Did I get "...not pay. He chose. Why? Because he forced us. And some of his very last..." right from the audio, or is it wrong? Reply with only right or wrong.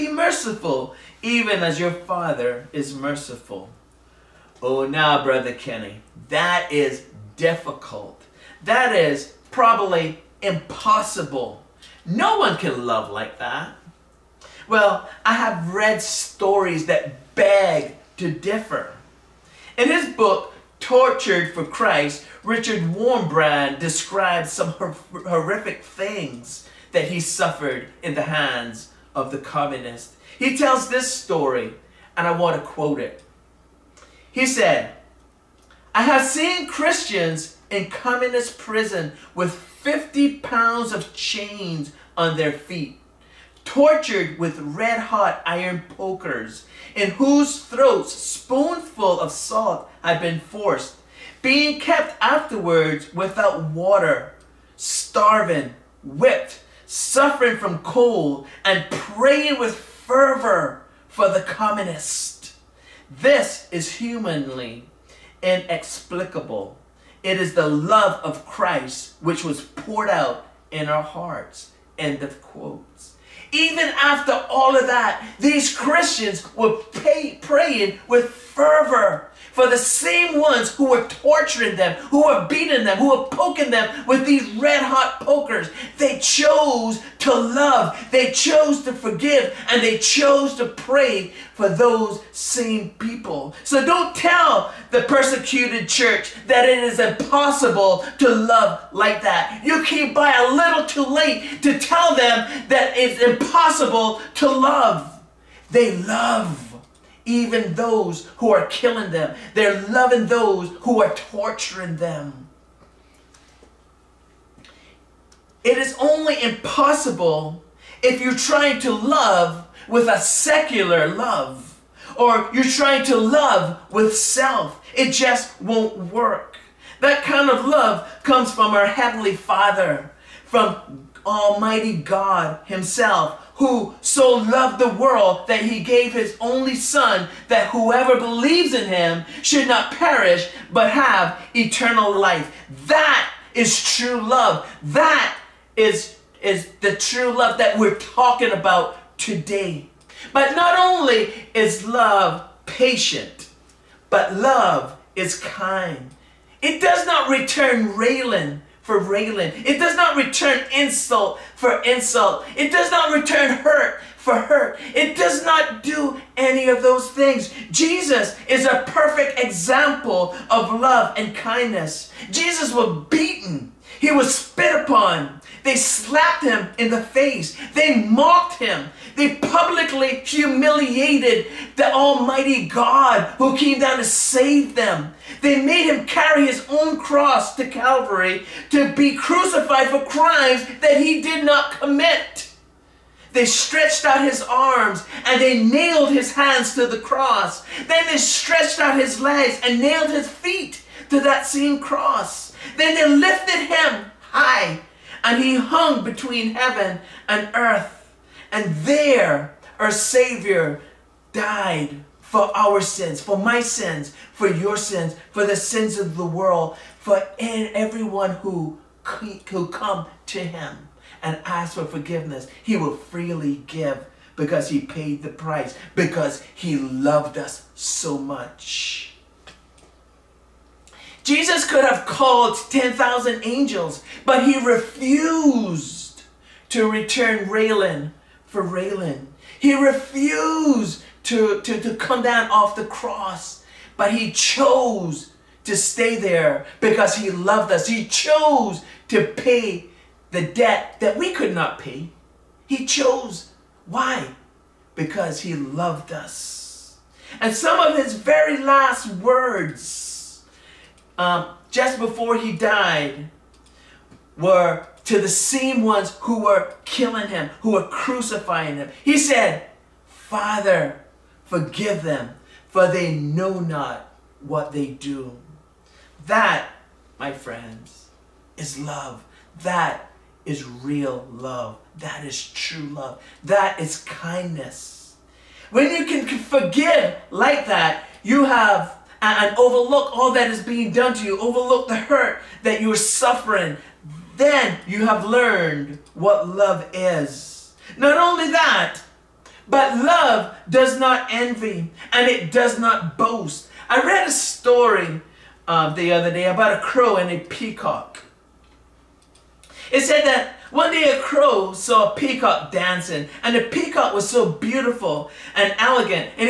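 wrong.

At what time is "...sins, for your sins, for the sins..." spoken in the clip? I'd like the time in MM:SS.
03:33.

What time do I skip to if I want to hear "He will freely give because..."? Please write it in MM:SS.
03:42.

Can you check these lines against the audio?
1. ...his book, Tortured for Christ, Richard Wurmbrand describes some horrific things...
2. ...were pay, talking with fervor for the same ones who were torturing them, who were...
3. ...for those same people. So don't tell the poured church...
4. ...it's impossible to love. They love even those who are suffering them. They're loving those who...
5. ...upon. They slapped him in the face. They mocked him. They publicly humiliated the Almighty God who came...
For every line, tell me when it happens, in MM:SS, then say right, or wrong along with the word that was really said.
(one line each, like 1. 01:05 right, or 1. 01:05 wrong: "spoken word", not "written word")
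1. 00:19 right
2. 01:16 wrong: "praying", not "talking"
3. 01:31 wrong: "persecuted", not "poured"
4. 01:42 wrong: "killing", not "suffering"
5. 02:54 right.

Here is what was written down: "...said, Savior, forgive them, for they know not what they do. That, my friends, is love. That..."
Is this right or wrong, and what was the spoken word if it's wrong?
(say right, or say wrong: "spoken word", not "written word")
wrong: "Father", not "Savior".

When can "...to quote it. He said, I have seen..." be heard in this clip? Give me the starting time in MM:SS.
00:32.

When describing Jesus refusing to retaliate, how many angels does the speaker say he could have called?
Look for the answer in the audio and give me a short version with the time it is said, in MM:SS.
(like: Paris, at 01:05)
10,000, at 03:52.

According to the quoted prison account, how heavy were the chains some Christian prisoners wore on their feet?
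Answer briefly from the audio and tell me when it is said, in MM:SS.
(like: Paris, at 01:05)
50 pounds, at 00:39.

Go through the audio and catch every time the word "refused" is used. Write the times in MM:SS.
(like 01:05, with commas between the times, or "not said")
03:54, 03:59.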